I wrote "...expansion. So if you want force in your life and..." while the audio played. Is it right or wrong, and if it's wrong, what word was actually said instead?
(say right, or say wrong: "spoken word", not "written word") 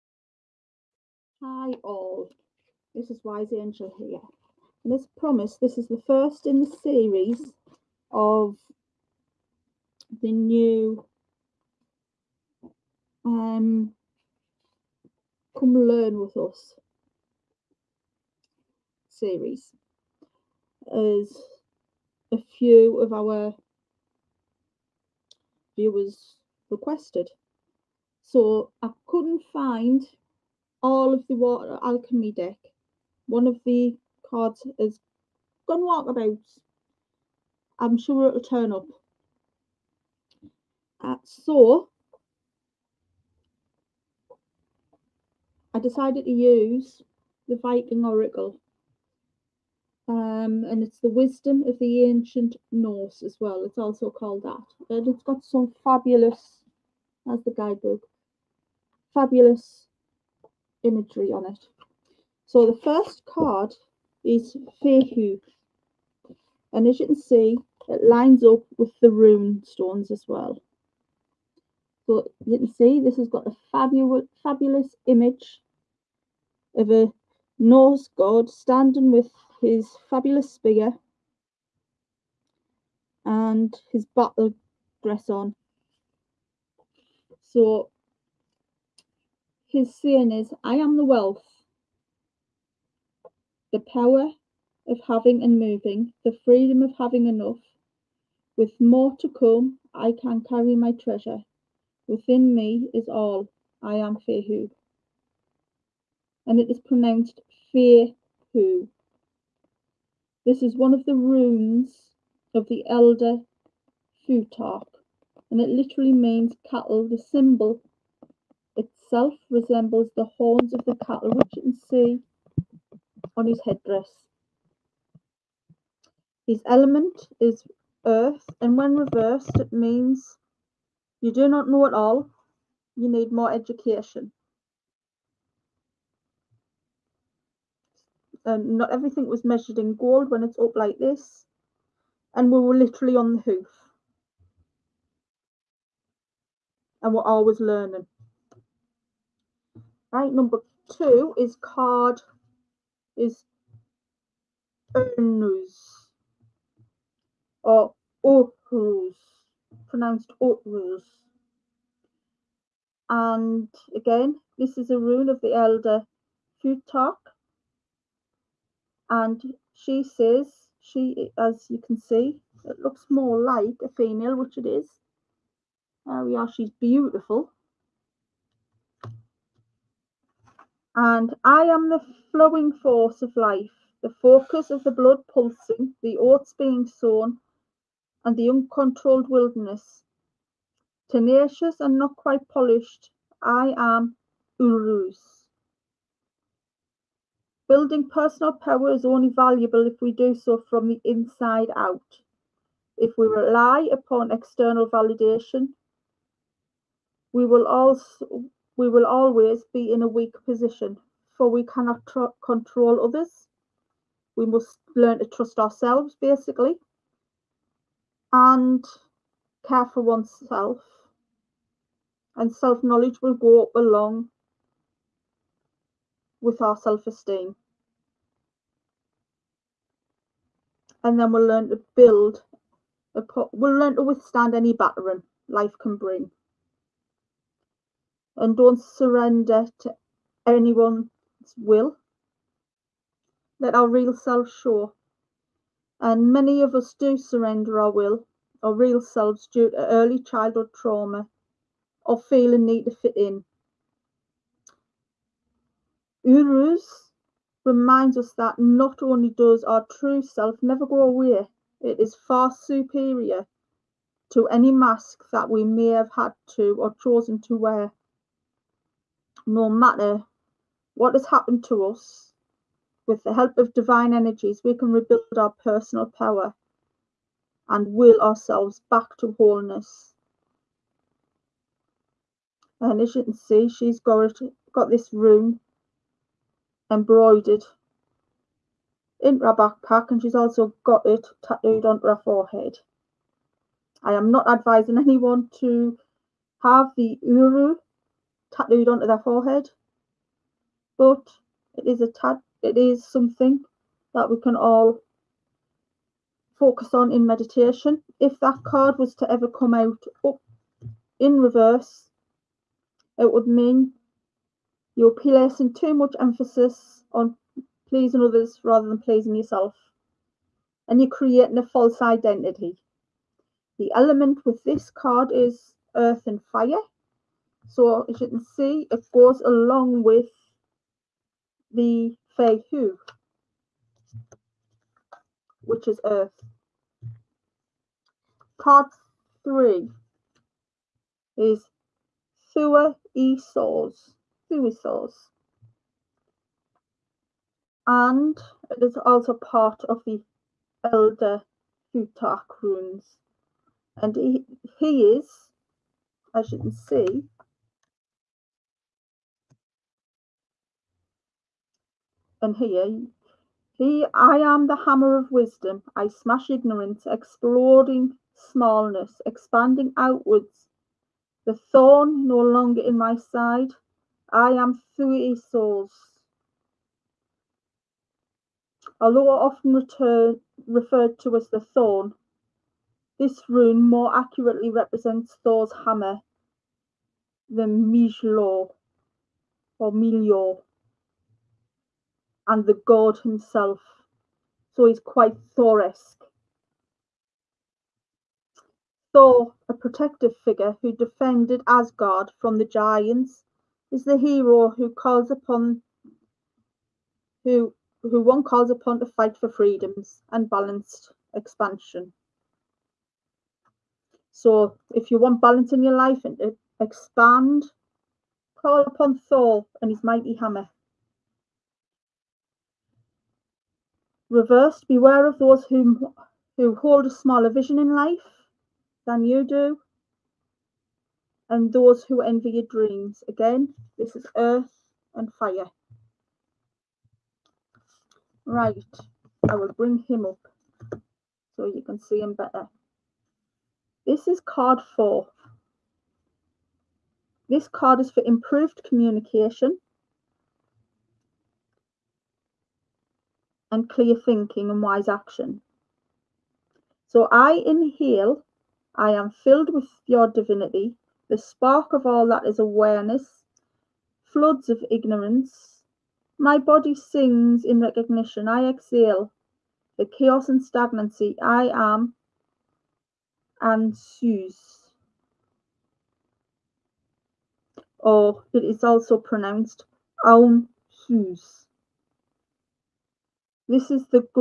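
wrong: "balance", not "force".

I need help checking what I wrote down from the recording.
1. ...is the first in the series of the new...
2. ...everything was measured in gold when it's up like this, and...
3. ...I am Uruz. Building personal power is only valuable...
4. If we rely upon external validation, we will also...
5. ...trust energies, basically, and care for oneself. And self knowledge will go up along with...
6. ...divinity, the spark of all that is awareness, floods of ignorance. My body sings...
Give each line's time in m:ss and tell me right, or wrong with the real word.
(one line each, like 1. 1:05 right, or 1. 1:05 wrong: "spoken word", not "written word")
1. 0:05 right
2. 2:18 right
3. 3:13 right
4. 3:22 right
5. 3:35 wrong: "ourselves", not "energies"
6. 7:40 right.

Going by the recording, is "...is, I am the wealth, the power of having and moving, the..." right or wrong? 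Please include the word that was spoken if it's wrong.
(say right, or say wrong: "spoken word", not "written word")
right.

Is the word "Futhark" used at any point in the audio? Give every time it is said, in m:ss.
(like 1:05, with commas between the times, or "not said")
1:54, 2:46, 5:51.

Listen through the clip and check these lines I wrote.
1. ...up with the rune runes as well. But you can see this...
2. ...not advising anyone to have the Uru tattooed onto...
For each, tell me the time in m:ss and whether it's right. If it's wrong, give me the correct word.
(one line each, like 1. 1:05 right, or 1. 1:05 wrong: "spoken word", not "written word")
1. 1:08 wrong: "stones", not "runes"
2. 4:54 right.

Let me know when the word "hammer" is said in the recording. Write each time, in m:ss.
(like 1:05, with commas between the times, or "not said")
6:04, 6:25, 7:00.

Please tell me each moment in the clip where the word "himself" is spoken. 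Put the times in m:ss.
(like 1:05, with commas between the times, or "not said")
6:33.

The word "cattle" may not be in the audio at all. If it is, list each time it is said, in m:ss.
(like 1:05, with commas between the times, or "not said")
1:56, 2:01.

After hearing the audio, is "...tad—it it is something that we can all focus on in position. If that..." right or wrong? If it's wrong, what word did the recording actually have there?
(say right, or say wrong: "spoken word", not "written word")
wrong: "meditation", not "position".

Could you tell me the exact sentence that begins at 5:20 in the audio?
And you're creating a false identity.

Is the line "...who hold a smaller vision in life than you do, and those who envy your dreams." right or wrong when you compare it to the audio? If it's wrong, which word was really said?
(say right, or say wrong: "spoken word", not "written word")
right.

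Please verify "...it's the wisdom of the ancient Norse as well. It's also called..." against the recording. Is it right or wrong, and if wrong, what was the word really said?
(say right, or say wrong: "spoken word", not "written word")
right.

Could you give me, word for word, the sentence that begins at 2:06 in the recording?
His element is earth, and when reversed, it means you do not know it all, you need more education.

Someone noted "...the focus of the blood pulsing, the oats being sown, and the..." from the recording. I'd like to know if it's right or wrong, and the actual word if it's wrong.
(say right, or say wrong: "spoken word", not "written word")
right.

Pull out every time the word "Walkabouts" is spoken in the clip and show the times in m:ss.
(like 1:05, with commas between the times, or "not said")
0:35.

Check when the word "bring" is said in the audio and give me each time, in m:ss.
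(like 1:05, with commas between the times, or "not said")
3:55, 7:19.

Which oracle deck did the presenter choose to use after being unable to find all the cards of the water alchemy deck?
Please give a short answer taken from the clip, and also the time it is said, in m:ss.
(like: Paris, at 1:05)
Viking Oracle, at 0:47.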